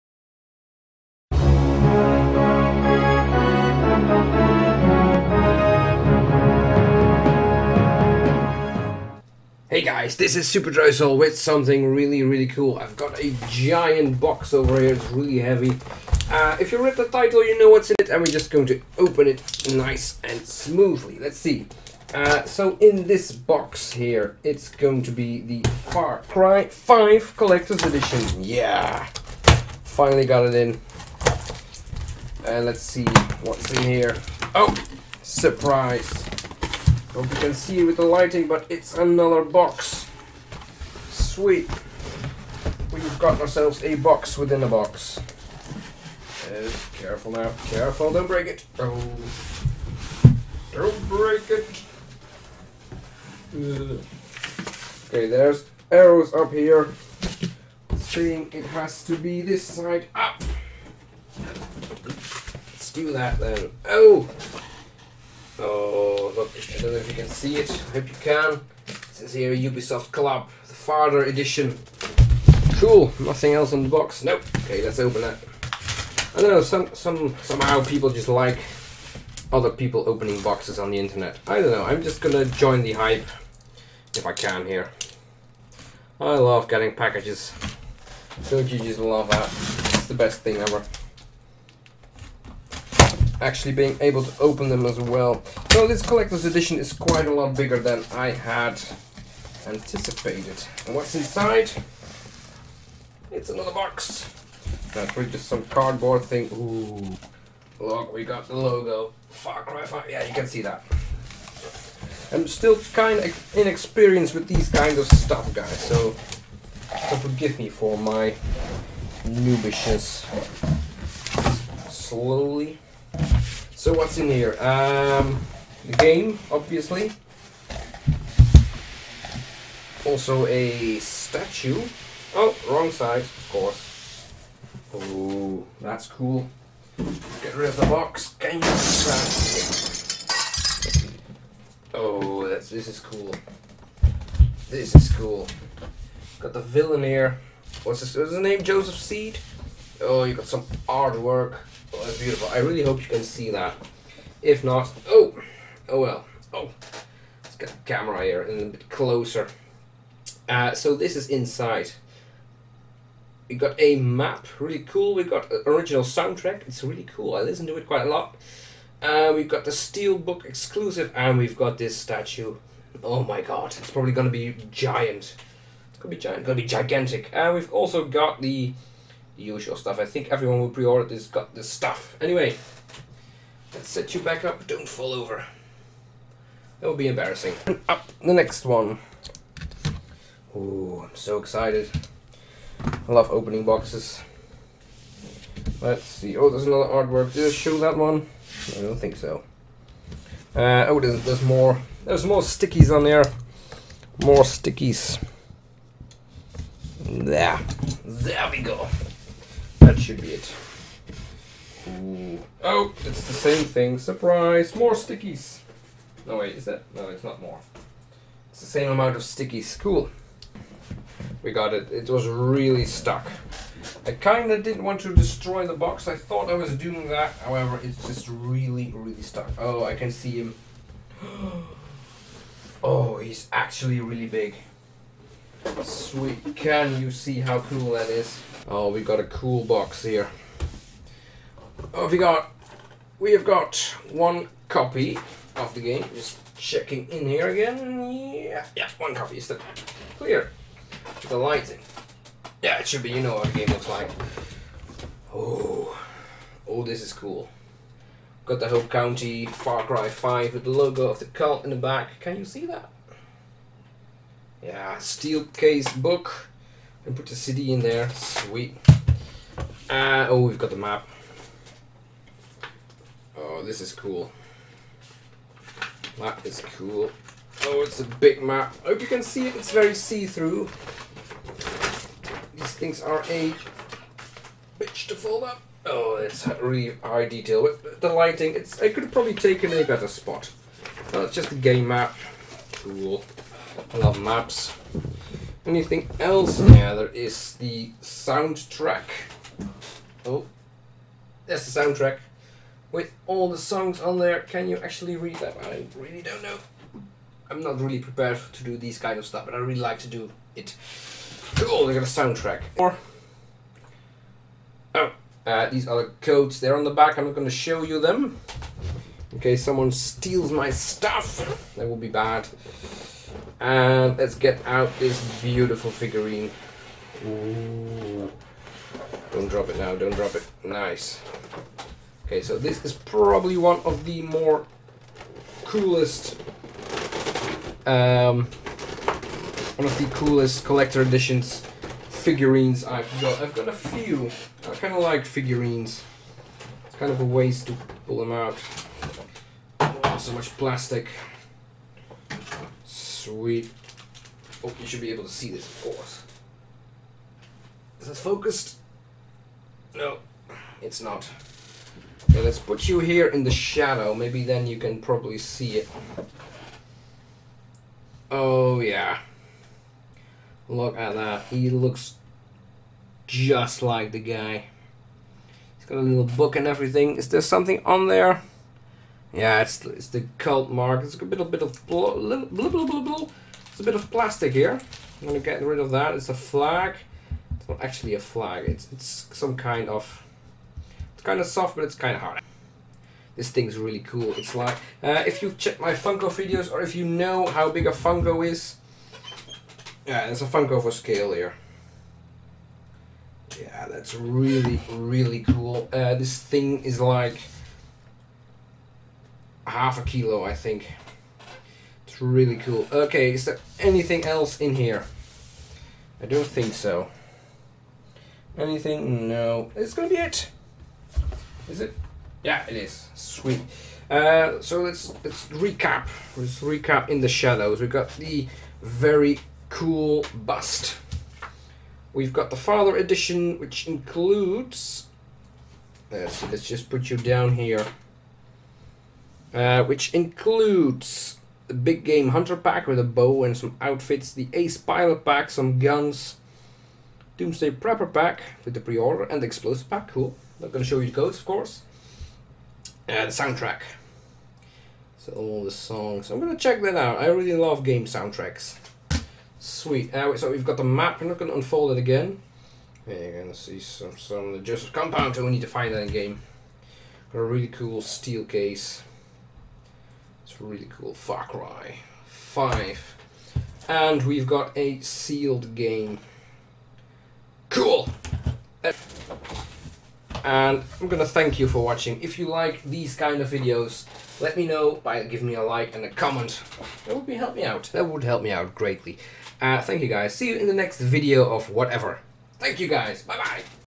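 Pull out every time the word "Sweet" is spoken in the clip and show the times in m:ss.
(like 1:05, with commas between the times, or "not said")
0:41, 3:55, 4:28, 5:53, 7:03, 7:39.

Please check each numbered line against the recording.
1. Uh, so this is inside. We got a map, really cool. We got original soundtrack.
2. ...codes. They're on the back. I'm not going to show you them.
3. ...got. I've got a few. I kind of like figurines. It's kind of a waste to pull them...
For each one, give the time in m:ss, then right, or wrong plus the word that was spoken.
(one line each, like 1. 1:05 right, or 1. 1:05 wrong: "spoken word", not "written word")
1. 2:40 right
2. 5:16 right
3. 5:43 right.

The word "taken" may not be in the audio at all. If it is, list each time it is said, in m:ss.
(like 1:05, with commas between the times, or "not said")
4:49.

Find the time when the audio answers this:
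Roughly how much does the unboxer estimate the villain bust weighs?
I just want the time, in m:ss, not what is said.
6:49.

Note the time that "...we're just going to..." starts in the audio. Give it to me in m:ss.
0:18.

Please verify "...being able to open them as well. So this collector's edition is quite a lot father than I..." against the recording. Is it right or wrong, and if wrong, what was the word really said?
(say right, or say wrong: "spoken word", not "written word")
wrong: "bigger", not "father".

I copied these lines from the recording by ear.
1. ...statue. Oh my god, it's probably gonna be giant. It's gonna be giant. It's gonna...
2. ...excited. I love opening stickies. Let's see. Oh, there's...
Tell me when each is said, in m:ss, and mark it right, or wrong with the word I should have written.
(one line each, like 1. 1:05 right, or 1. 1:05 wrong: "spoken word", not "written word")
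1. 2:51 right
2. 3:11 wrong: "boxes", not "stickies".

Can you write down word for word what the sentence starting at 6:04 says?
Maybe then you can probably see it.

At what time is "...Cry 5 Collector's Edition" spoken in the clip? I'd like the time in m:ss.
0:26.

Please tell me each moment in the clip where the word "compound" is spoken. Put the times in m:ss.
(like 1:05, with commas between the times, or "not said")
7:44.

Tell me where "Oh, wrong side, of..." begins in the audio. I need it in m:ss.
2:12.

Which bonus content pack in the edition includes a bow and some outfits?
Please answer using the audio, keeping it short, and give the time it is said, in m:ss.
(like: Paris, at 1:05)
Big Game Hunter pack, at 7:21.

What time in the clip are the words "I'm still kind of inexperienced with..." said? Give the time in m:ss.
1:52.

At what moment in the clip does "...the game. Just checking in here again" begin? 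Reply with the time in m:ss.
4:05.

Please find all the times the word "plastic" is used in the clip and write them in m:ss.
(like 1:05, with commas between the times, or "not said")
5:50, 6:24.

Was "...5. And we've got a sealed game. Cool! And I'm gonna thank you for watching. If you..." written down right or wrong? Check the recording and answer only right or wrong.
right.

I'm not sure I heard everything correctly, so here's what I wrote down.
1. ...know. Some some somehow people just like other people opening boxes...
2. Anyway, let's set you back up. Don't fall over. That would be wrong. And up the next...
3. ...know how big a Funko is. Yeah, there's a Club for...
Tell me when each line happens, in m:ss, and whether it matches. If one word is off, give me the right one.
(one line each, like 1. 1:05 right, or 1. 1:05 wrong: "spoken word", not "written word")
1. 1:16 right
2. 3:02 wrong: "embarrassing", not "wrong"
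3. 6:37 wrong: "Funko", not "Club".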